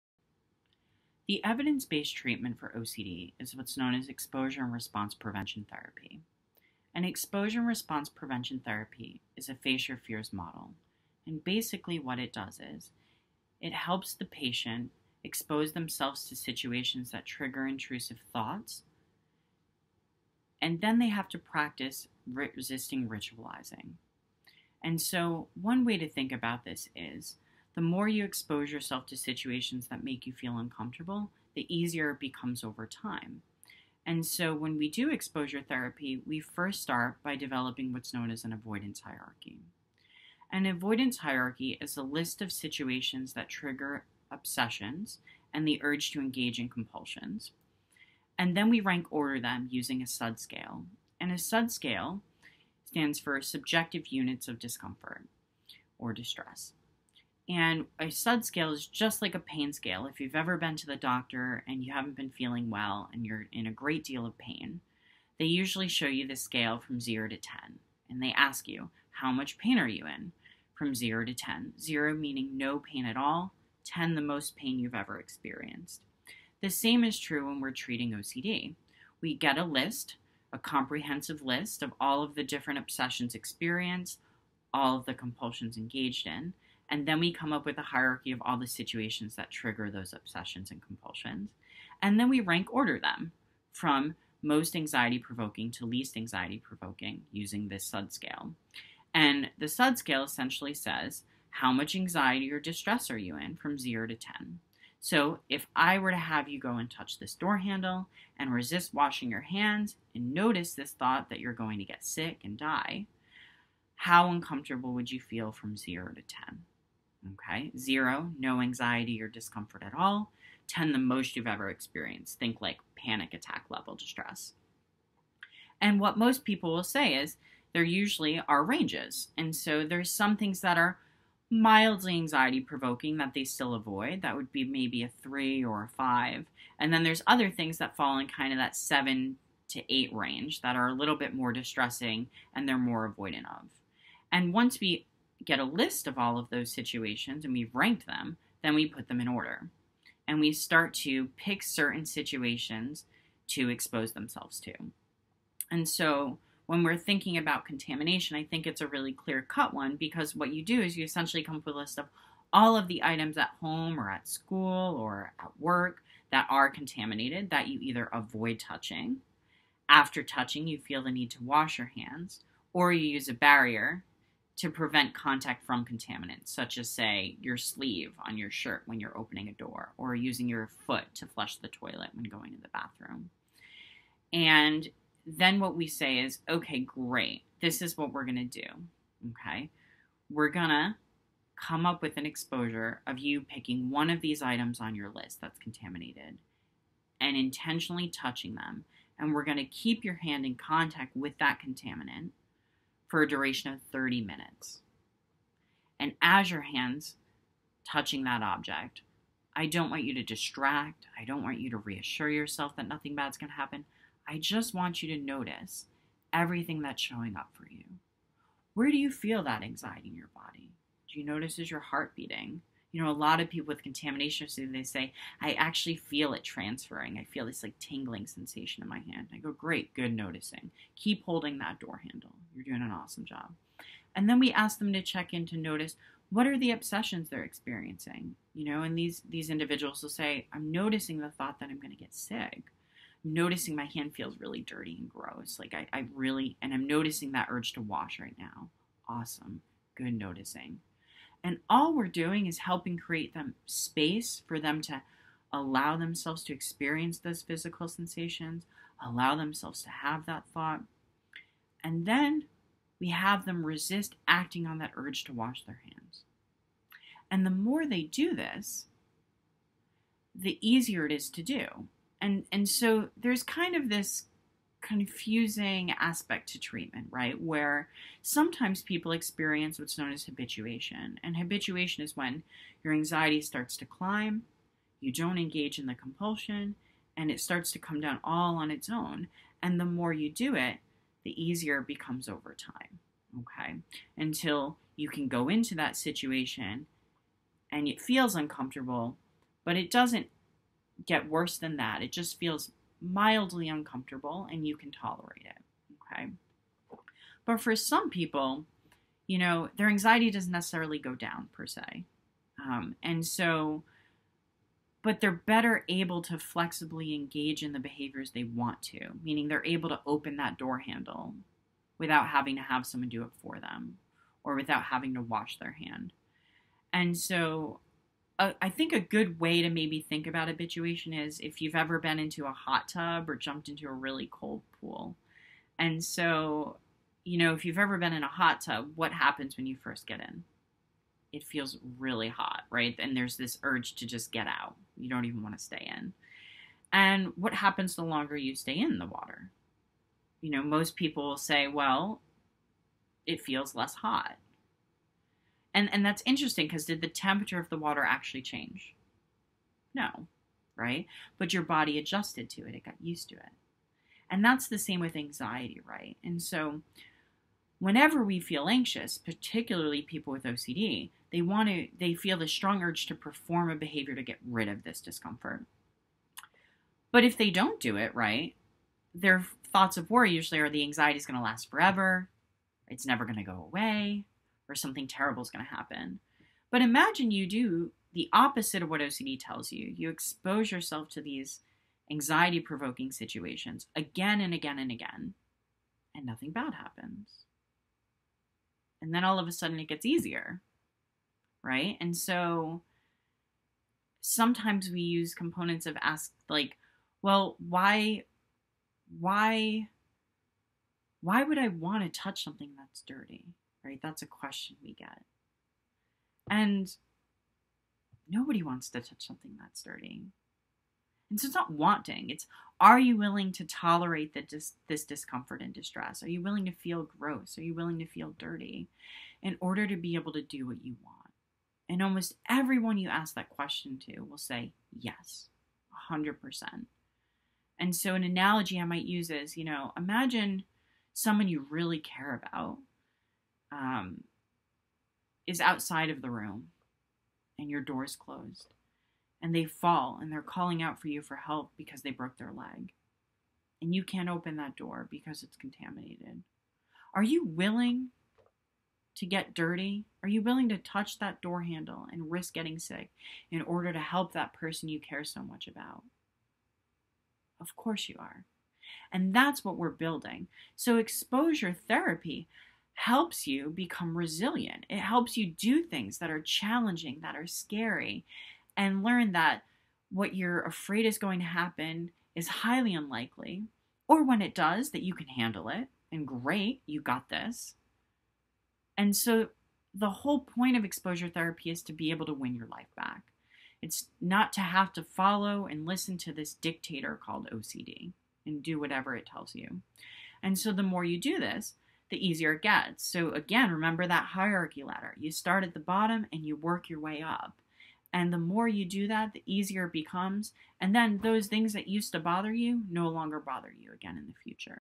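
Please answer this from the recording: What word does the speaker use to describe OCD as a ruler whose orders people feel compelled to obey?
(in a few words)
dictator.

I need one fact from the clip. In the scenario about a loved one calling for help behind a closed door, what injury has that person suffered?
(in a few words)
broke their leg.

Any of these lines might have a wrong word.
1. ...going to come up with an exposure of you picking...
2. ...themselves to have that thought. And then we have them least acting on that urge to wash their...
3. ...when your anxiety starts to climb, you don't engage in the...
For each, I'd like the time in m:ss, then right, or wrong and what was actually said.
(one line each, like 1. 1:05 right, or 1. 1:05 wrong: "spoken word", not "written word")
1. 3:10 right
2. 4:19 wrong: "resist", not "least"
3. 4:42 right.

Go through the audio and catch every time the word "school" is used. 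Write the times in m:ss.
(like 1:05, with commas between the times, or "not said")
2:44.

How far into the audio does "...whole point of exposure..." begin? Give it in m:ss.
8:10.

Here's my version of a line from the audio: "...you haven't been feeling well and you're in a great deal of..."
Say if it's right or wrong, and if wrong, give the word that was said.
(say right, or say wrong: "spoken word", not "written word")
right.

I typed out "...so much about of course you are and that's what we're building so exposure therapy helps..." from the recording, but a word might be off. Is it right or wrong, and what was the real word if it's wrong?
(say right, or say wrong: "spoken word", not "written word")
right.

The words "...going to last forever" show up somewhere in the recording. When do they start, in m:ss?
6:21.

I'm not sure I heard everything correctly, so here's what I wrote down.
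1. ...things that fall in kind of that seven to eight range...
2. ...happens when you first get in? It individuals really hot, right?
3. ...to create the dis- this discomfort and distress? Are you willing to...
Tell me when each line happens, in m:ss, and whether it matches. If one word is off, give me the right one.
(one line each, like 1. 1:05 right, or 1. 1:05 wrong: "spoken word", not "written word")
1. 2:17 right
2. 5:39 wrong: "feels", not "individuals"
3. 7:03 wrong: "tolerate", not "create".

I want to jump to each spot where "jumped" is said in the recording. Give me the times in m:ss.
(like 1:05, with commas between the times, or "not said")
5:33.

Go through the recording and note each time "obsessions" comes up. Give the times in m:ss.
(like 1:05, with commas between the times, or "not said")
0:44, 1:22, 1:30, 3:56.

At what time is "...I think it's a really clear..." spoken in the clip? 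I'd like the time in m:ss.
2:38.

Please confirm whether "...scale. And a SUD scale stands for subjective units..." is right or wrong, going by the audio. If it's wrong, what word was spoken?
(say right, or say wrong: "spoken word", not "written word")
right.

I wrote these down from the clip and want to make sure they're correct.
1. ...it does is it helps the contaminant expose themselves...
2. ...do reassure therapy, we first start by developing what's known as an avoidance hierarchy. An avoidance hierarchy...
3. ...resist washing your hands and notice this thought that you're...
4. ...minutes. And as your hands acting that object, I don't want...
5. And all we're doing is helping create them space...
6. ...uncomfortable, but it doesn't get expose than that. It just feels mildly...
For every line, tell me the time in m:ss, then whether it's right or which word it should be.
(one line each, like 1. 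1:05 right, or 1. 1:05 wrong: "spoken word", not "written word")
1. 0:12 wrong: "patient", not "contaminant"
2. 0:34 wrong: "exposure", not "reassure"
3. 1:48 right
4. 3:24 wrong: "touching", not "acting"
5. 4:11 right
6. 4:58 wrong: "worse", not "expose".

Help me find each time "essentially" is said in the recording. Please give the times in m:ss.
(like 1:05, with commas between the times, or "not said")
1:40, 2:41.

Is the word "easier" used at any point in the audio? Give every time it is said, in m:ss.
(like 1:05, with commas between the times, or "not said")
0:31, 4:30, 4:51, 6:40, 8:22, 8:29.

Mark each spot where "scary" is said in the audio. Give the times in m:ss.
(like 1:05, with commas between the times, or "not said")
7:57.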